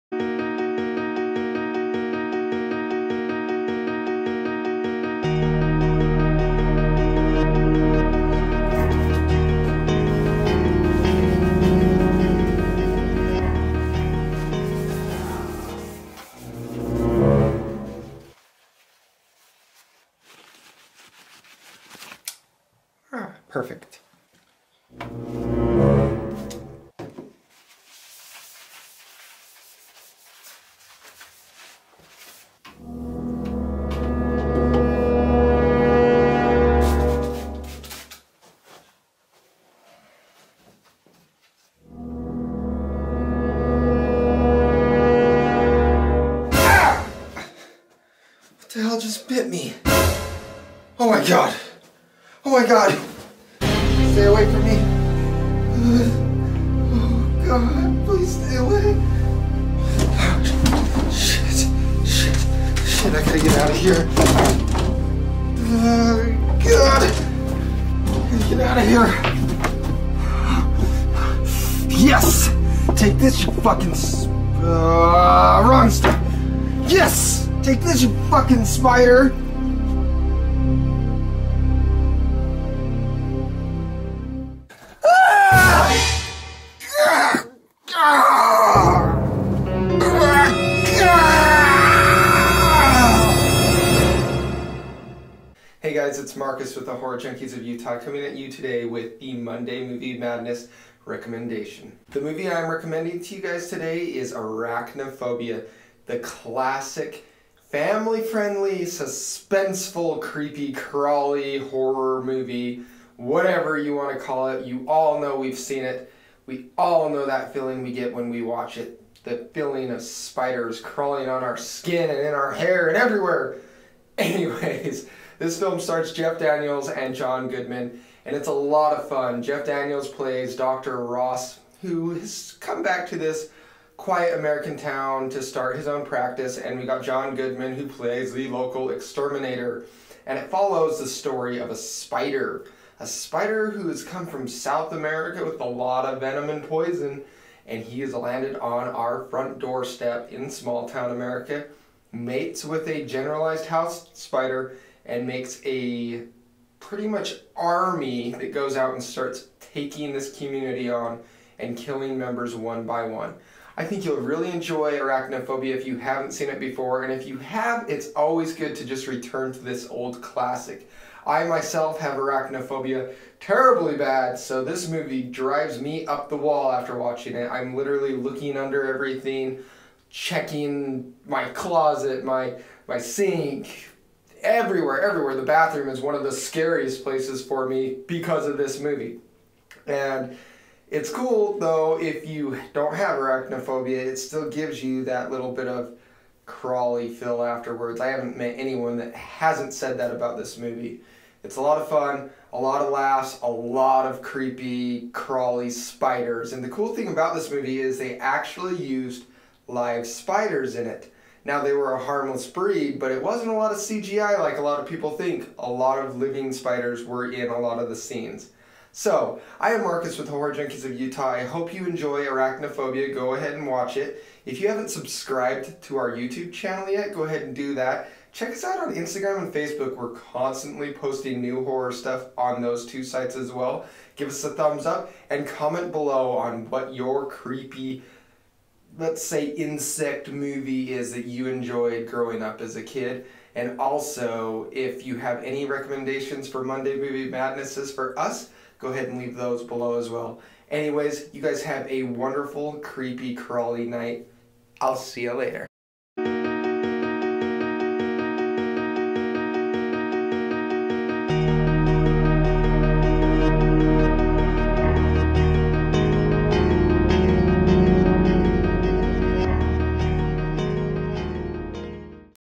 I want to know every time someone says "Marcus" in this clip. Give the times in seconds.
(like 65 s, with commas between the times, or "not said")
96 s, 219 s.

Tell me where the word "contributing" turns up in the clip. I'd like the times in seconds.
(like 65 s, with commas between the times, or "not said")
not said.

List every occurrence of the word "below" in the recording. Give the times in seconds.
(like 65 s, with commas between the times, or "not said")
235 s, 249 s.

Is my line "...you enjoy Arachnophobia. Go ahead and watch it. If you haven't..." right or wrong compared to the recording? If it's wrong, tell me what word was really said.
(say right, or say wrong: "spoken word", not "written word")
right.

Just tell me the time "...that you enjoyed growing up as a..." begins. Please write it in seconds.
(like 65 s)
241 s.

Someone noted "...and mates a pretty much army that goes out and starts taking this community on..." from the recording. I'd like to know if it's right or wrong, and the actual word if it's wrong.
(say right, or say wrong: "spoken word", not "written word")
wrong: "makes", not "mates".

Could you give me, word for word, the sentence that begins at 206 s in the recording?
And the cool thing about this movie is they actually used live spiders in it.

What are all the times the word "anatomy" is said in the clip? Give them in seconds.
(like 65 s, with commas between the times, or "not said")
not said.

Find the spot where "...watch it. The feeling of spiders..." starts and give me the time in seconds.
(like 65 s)
118 s.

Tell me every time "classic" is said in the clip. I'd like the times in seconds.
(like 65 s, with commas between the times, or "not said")
106 s, 170 s.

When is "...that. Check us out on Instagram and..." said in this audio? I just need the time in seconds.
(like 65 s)
227 s.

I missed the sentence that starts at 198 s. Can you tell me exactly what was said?
I haven't met anyone that hasn't said that about this movie.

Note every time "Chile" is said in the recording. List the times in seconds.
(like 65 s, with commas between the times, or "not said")
not said.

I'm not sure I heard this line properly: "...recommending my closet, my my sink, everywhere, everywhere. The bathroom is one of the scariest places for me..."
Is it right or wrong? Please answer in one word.
wrong.